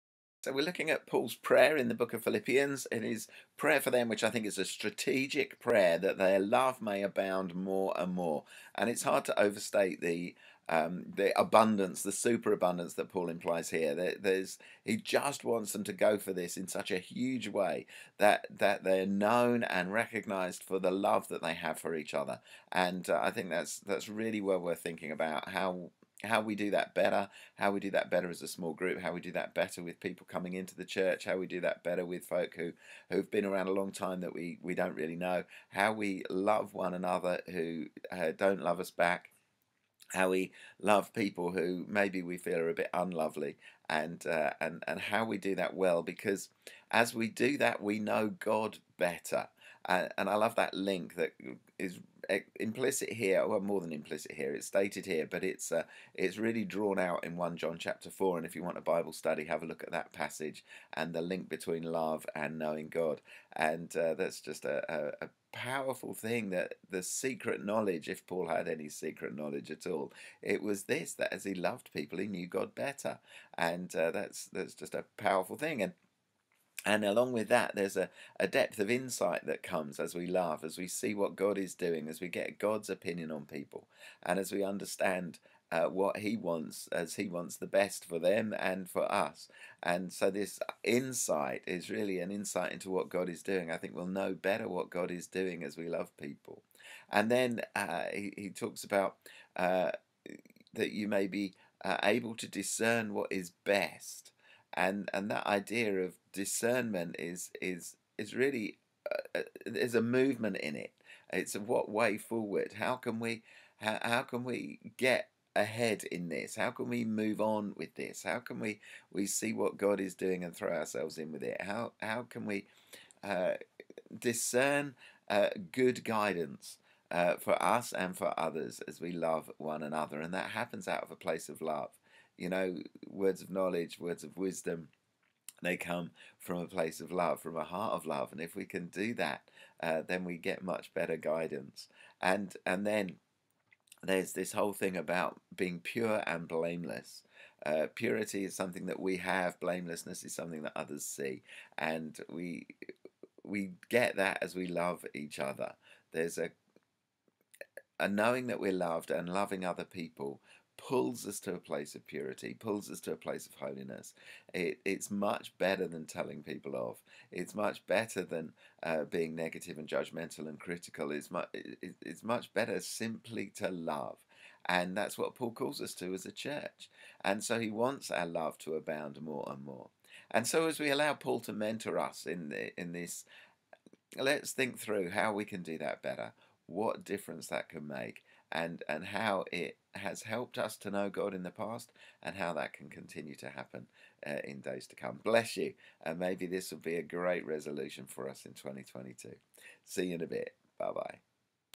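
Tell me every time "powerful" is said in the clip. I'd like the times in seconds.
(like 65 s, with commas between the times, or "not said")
65 s, 75 s.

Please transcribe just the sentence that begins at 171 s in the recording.
It's, mu- it, it's much better simply to love.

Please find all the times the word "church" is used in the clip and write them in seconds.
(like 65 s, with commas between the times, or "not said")
30 s, 176 s.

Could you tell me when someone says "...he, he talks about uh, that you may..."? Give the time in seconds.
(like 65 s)
98 s.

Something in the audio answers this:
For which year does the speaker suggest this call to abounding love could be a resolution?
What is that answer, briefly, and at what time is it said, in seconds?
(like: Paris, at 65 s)
2022, at 198 s.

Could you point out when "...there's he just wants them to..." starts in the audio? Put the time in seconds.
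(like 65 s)
14 s.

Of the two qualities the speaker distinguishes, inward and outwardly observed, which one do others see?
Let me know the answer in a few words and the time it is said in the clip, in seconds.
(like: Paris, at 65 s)
Blamelessness, at 149 s.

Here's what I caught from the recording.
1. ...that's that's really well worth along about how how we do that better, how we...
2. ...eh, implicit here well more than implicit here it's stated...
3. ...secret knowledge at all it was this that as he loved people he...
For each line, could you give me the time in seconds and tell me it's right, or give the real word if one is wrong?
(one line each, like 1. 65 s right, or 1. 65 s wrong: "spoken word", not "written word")
1. 23 s wrong: "thinking", not "along"
2. 52 s right
3. 68 s right.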